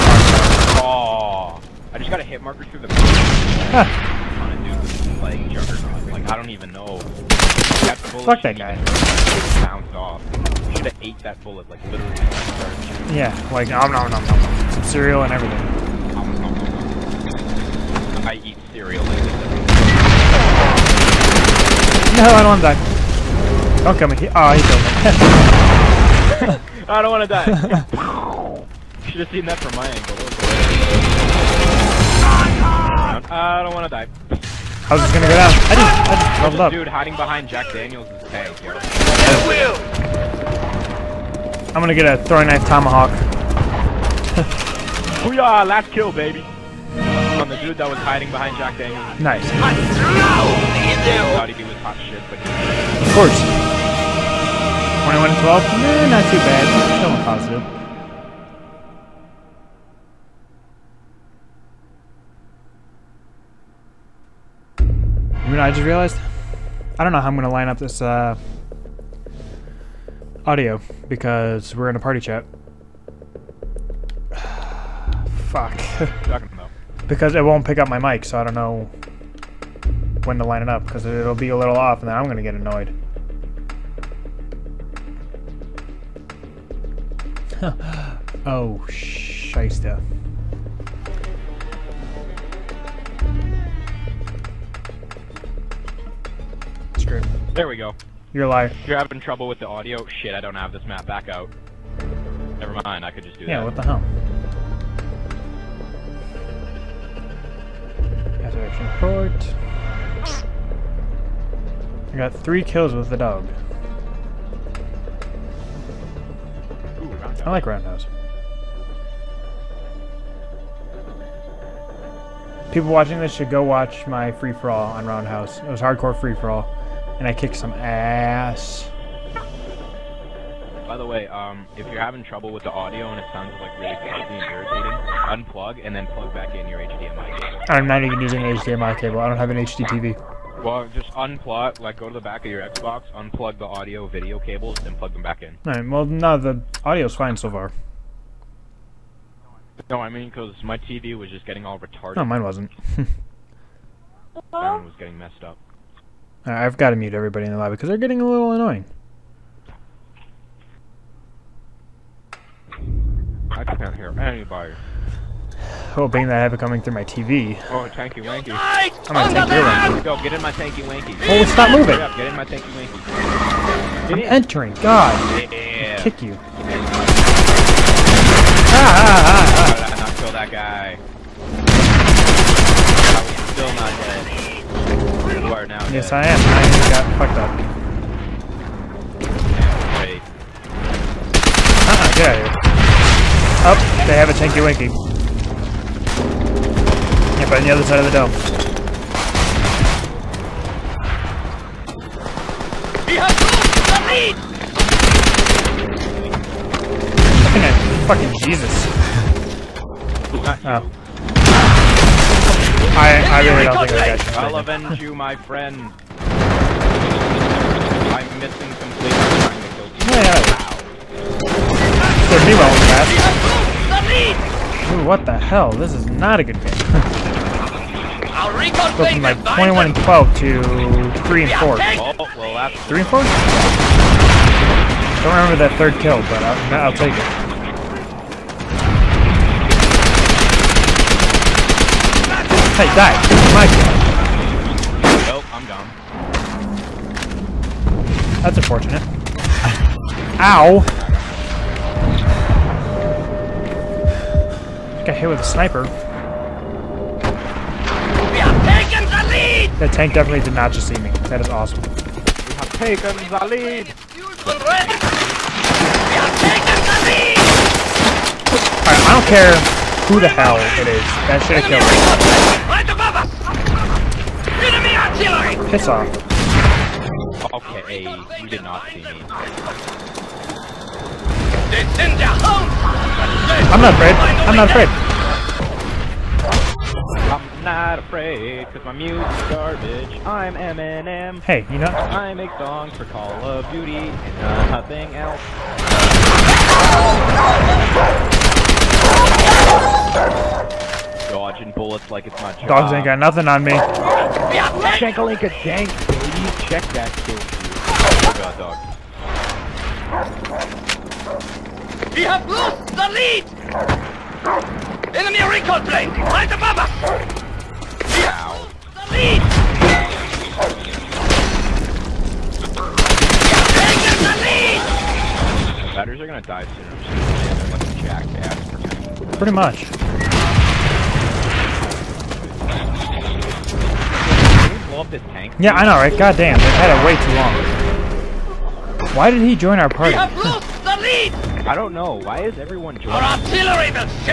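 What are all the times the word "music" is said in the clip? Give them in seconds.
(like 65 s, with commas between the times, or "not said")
288 s.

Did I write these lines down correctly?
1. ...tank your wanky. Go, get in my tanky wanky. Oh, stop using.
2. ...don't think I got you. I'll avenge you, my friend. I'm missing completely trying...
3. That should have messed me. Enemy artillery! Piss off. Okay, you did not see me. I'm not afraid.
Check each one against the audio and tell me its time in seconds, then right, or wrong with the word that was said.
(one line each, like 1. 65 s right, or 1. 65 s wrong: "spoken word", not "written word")
1. 169 s wrong: "moving", not "using"
2. 213 s right
3. 271 s wrong: "killed", not "messed".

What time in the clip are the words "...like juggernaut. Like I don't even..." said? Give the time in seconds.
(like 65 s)
5 s.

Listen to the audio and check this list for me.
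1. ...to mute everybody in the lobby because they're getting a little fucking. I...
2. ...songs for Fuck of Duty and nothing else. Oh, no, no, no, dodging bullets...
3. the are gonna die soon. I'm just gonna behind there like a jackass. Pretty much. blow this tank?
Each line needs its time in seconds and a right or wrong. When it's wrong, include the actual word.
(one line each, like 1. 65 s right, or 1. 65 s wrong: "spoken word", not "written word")
1. 156 s wrong: "annoying", not "fucking"
2. 292 s wrong: "Call", not "Fuck"
3. 326 s wrong: "stand", not "behind".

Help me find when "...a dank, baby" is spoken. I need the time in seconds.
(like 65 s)
305 s.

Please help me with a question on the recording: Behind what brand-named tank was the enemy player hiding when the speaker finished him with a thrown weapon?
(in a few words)
Jack Daniels.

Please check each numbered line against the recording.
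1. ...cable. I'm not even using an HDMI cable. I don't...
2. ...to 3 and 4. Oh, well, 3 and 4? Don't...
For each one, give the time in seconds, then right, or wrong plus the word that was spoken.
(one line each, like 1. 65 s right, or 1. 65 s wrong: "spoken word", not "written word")
1. 137 s right
2. 230 s right.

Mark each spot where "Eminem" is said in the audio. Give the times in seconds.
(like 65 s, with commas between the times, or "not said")
290 s.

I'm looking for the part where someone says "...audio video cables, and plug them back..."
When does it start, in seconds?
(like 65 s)
143 s.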